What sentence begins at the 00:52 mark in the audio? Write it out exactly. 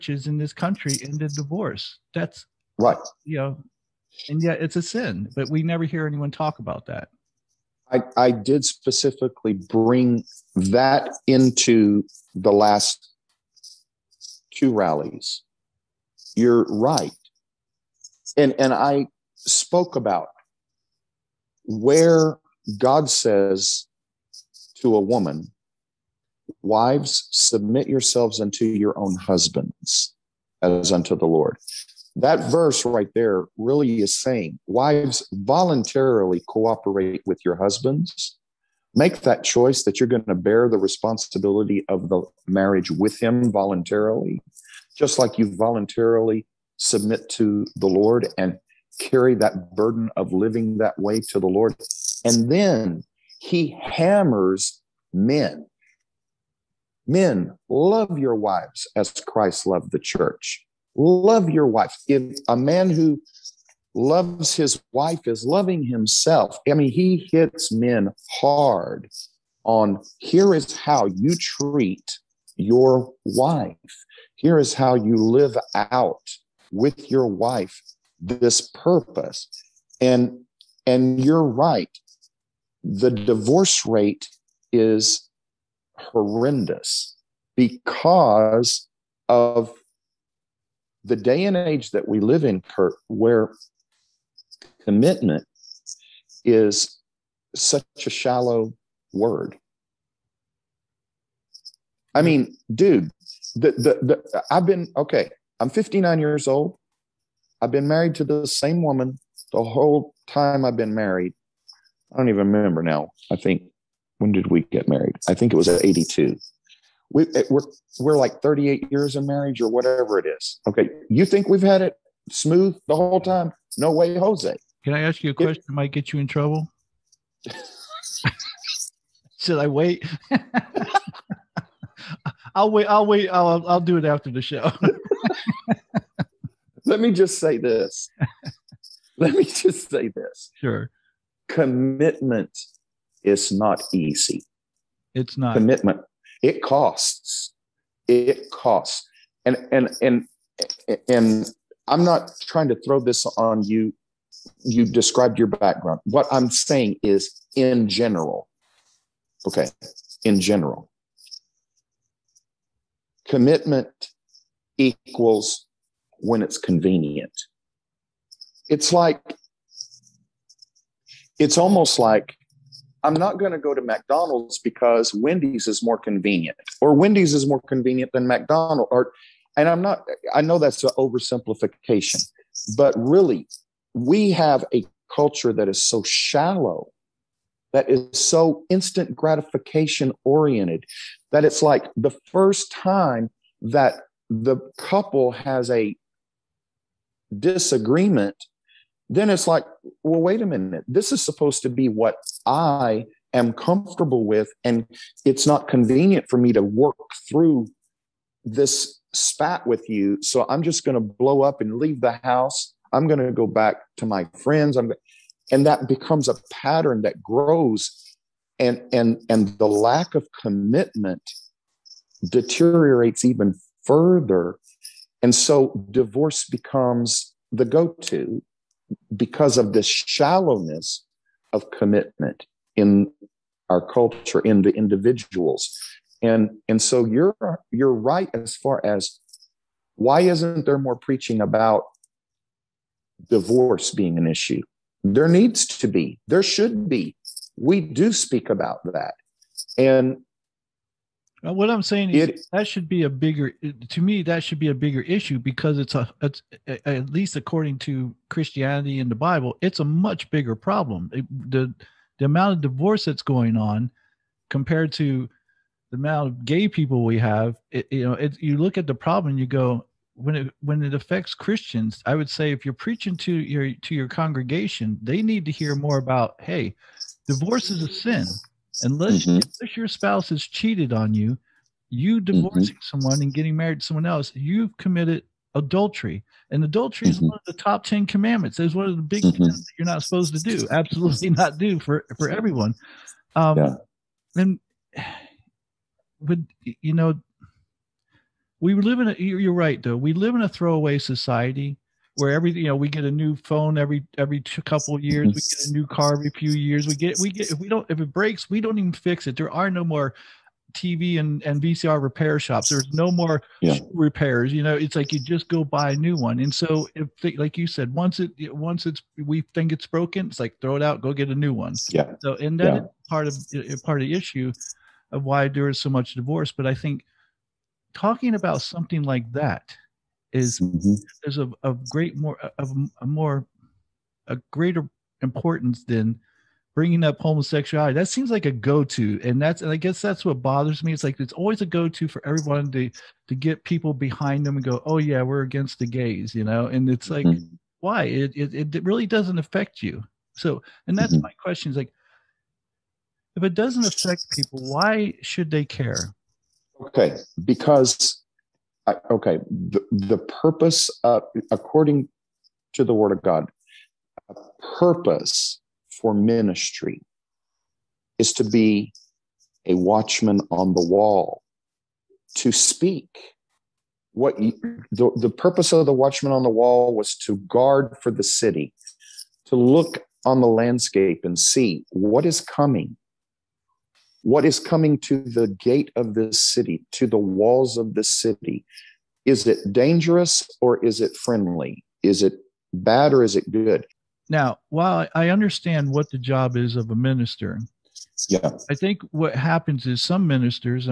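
And then he hammers men Men, love your wives as Christ loved the church.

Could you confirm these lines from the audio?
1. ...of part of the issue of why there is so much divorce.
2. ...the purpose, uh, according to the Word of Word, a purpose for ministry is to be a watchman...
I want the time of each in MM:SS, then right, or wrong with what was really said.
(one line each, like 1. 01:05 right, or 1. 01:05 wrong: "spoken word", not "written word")
1. 05:23 right
2. 05:59 wrong: "God", not "Word".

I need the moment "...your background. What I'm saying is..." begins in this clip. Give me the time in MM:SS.
02:35.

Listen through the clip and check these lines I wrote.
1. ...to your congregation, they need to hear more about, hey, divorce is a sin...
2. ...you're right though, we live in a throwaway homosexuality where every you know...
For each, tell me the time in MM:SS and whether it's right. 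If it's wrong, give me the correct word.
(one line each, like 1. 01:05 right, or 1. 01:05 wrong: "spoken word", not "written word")
1. 04:33 right
2. 04:59 wrong: "society", not "homosexuality".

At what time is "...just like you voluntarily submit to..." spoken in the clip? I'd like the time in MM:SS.
00:44.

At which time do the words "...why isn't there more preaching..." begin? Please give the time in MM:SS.
03:59.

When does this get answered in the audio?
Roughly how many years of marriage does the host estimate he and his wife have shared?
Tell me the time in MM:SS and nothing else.
01:58.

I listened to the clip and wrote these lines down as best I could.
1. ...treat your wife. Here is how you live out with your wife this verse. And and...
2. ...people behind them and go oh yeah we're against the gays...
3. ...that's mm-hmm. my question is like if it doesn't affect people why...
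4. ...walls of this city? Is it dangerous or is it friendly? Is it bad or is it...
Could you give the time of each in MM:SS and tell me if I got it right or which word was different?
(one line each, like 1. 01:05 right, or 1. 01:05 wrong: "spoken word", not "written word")
1. 01:11 wrong: "purpose", not "verse"
2. 05:43 right
3. 05:50 right
4. 06:27 right.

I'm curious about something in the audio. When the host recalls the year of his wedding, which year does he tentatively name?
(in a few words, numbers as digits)
1982.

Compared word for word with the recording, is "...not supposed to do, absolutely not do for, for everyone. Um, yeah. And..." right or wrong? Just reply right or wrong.
right.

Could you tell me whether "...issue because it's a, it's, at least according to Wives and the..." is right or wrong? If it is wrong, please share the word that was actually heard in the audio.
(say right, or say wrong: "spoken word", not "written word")
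wrong: "Christianity", not "Wives".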